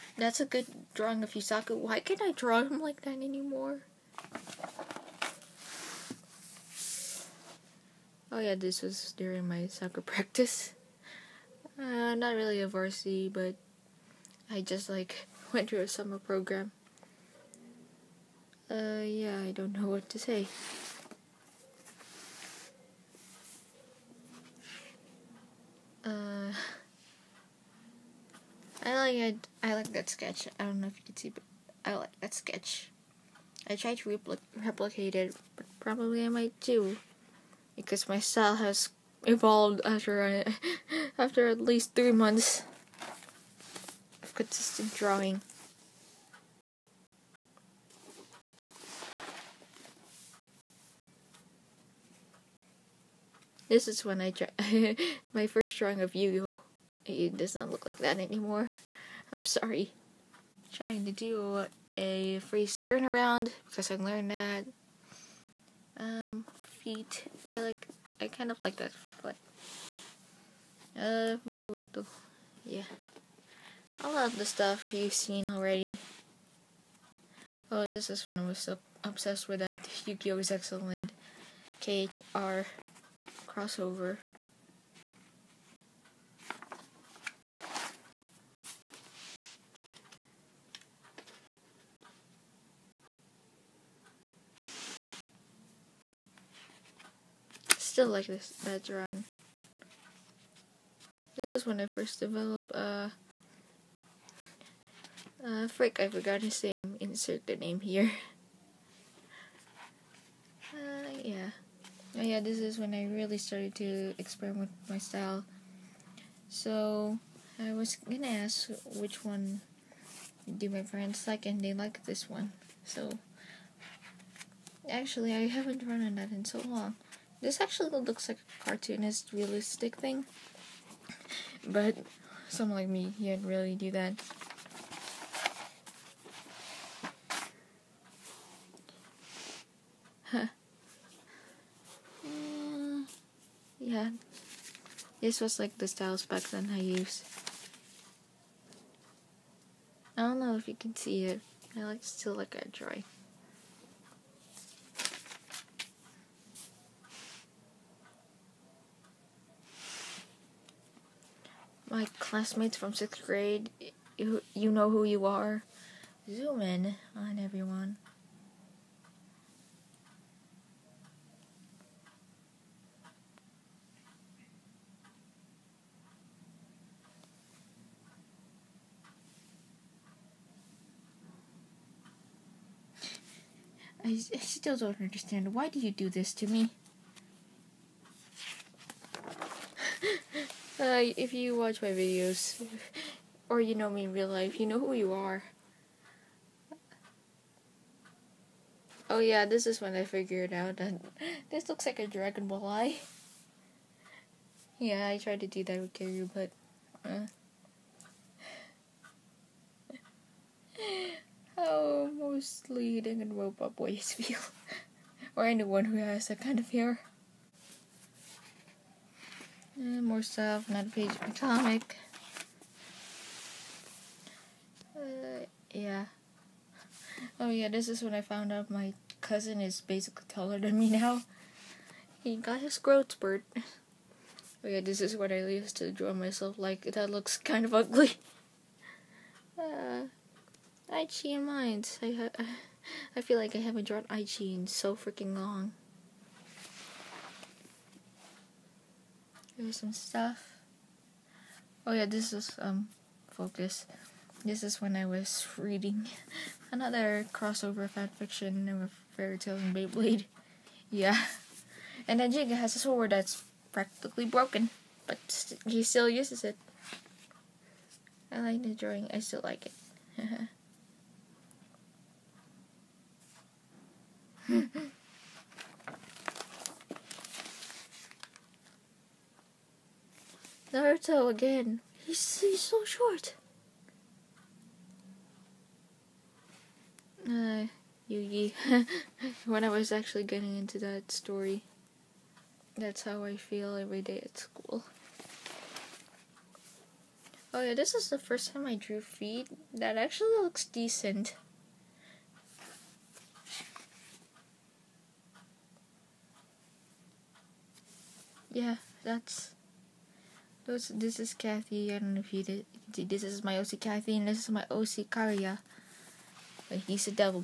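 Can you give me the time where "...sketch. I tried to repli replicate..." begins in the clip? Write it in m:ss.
0:32.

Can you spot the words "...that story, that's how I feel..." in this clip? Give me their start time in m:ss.
4:50.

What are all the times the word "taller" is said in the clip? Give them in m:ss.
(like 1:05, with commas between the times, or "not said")
3:50.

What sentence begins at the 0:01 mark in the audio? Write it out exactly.
Why can't I draw him like that anymore?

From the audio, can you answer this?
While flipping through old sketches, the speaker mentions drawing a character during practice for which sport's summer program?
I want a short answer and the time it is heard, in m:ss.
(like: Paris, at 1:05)
Soccer, at 0:09.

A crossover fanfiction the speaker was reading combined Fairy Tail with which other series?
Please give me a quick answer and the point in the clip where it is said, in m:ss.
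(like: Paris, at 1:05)
Beyblade, at 4:19.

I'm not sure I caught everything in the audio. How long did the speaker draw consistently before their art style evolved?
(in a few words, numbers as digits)
3 months.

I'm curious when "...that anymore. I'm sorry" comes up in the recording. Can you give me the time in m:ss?
0:57.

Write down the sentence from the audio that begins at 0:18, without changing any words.
Uh, yeah, I don't know what to say.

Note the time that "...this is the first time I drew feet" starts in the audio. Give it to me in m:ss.
4:57.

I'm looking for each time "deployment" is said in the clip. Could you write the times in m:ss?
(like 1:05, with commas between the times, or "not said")
not said.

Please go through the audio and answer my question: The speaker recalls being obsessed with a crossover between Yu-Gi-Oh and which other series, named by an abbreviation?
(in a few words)
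KHR.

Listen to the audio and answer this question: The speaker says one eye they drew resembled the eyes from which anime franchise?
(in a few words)
Dragon Ball.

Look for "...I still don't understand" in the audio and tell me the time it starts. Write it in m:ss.
3:04.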